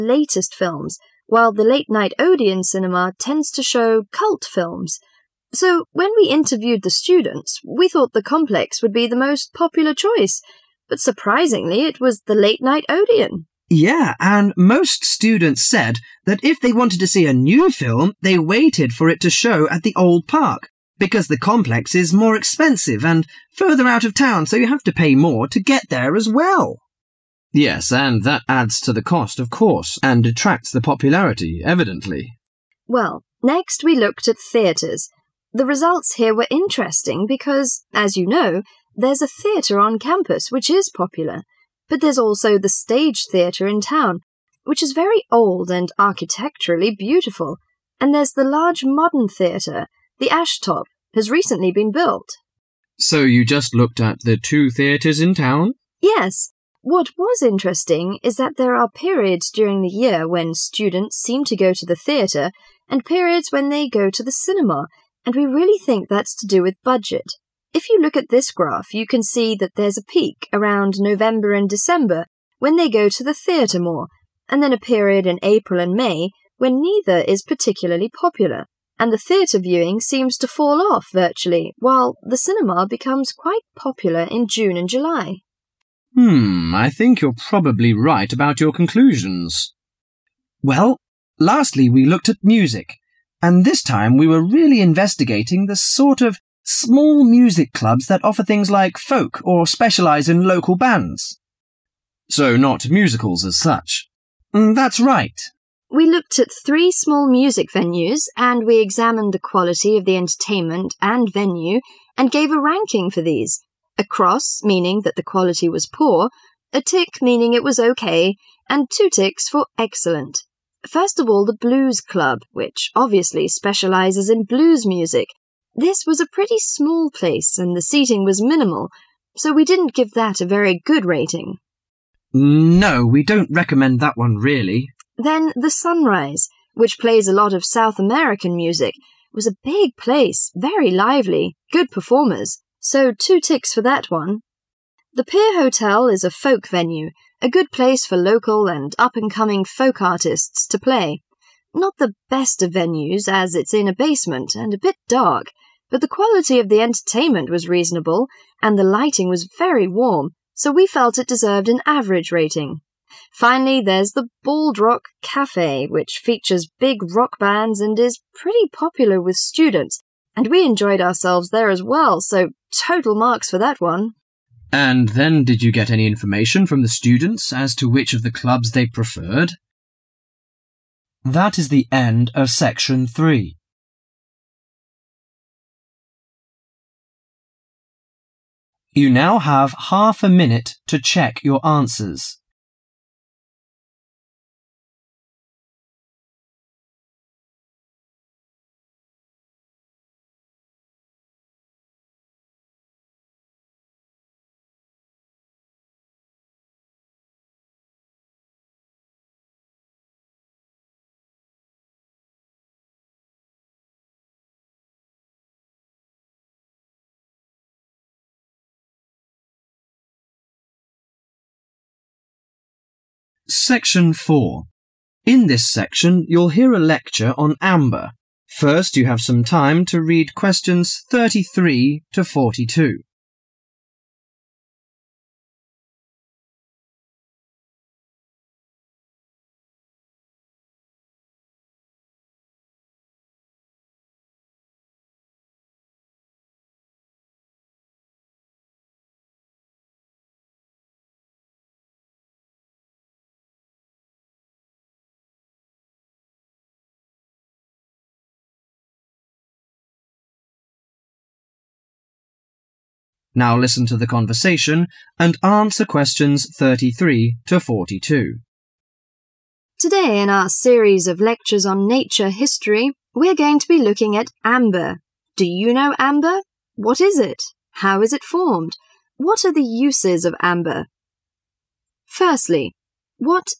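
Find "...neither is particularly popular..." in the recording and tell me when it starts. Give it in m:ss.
1:16.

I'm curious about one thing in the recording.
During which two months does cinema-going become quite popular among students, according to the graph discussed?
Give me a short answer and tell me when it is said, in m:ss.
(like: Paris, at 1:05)
June and July, at 1:24.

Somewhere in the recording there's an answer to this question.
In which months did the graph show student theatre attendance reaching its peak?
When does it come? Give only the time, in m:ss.
1:10.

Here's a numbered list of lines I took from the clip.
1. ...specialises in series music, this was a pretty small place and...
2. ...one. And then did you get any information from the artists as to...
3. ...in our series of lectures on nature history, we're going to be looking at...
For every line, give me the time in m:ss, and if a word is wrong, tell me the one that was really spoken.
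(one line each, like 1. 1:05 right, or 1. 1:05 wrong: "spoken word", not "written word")
1. 2:03 wrong: "blues", not "series"
2. 2:53 wrong: "students", not "artists"
3. 4:30 right.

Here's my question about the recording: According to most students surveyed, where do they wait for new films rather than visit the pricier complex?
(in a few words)
the old park.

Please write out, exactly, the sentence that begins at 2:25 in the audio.
The Pier Hotel is a folk venue, a good place for local and up and coming folk artists to play.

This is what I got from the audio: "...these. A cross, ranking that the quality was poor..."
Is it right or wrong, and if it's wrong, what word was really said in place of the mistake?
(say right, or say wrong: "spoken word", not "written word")
wrong: "meaning", not "ranking".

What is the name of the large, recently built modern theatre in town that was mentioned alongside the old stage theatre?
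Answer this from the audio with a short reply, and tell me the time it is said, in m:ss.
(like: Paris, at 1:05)
the Ashtop, at 0:50.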